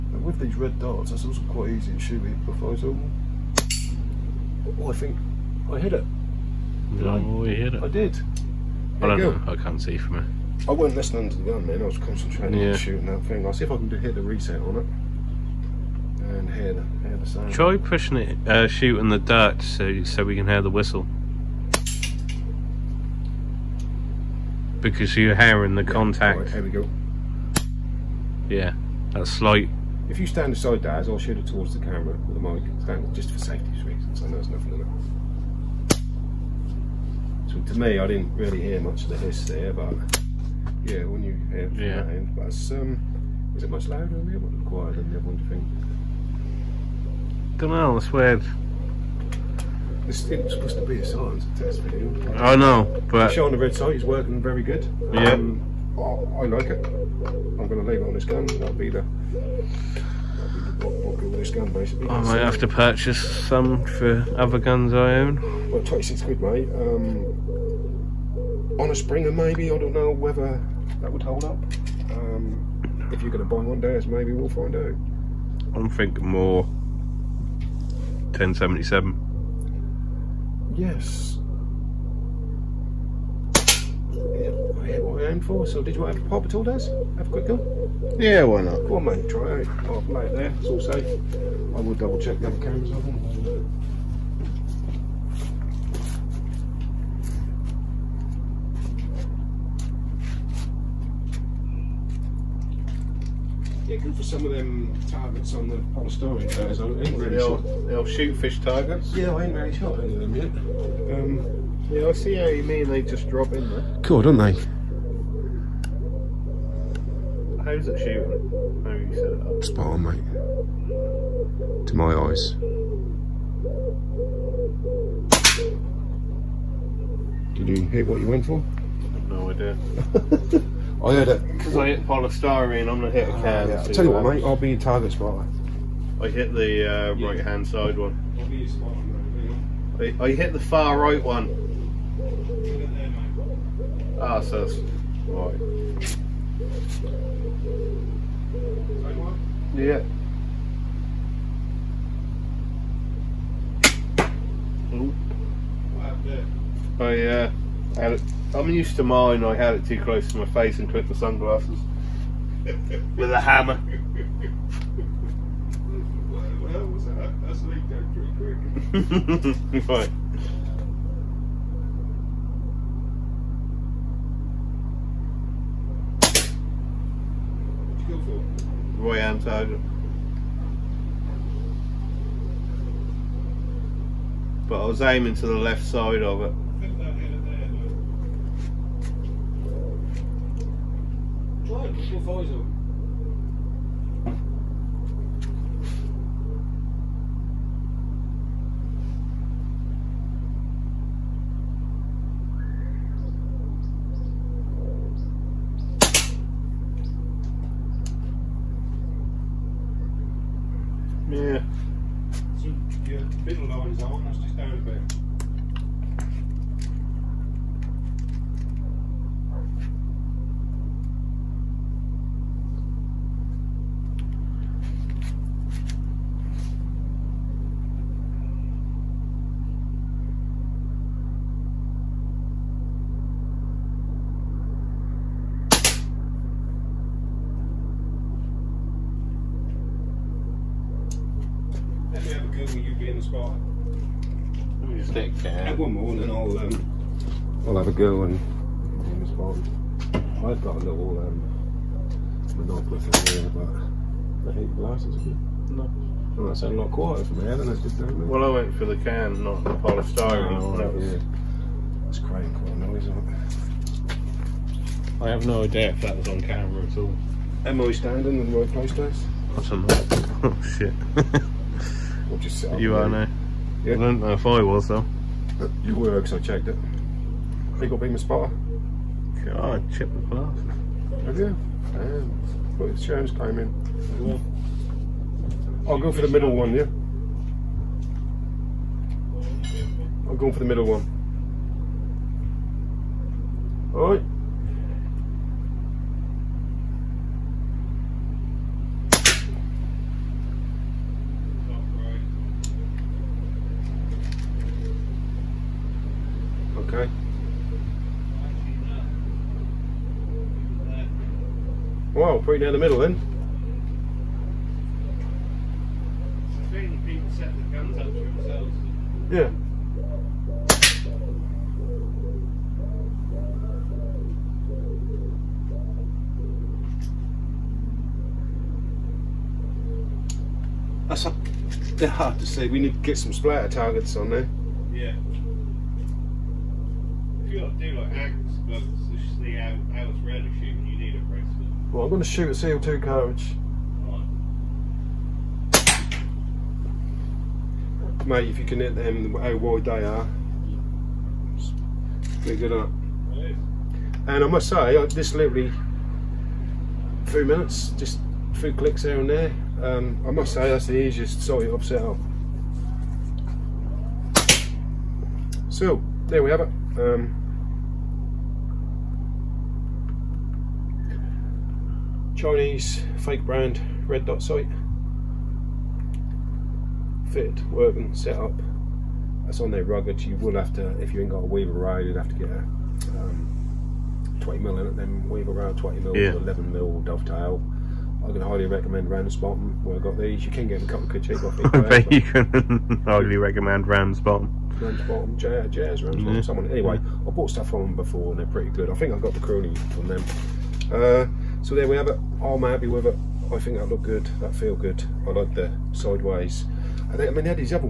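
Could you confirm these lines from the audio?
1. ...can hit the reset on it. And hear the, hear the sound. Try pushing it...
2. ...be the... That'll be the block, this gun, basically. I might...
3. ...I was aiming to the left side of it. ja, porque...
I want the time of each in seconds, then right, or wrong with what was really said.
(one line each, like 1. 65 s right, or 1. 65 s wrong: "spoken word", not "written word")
1. 13 s right
2. 58 s right
3. 184 s right.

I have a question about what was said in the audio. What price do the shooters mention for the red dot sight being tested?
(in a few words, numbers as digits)
26 quid.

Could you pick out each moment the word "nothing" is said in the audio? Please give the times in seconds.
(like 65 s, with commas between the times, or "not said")
34 s.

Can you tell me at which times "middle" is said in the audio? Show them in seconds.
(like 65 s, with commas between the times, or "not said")
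213 s, 286 s, 290 s, 312 s.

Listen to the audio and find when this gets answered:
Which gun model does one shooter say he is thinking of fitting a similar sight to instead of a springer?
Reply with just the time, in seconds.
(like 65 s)
78 s.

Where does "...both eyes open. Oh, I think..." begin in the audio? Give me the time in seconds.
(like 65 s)
2 s.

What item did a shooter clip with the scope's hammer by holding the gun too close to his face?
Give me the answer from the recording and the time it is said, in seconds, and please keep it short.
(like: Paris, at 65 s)
sunglasses, at 161 s.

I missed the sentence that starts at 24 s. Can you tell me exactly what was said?
because you're hearing the yeah, contact.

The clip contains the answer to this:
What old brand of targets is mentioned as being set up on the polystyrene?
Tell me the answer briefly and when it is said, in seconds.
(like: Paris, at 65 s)
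Shootfish, at 108 s.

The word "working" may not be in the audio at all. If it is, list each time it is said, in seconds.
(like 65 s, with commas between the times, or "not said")
54 s, 377 s.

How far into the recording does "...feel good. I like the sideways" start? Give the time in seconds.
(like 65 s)
404 s.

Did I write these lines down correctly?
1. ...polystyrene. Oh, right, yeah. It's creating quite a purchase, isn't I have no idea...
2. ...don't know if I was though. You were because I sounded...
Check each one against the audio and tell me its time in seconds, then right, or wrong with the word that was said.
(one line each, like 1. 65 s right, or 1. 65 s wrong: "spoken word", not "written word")
1. 259 s wrong: "noise", not "purchase"
2. 273 s wrong: "checked", not "sounded".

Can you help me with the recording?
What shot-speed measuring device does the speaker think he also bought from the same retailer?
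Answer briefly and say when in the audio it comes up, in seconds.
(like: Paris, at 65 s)
chrony, at 399 s.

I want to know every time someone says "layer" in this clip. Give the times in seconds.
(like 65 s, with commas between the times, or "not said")
not said.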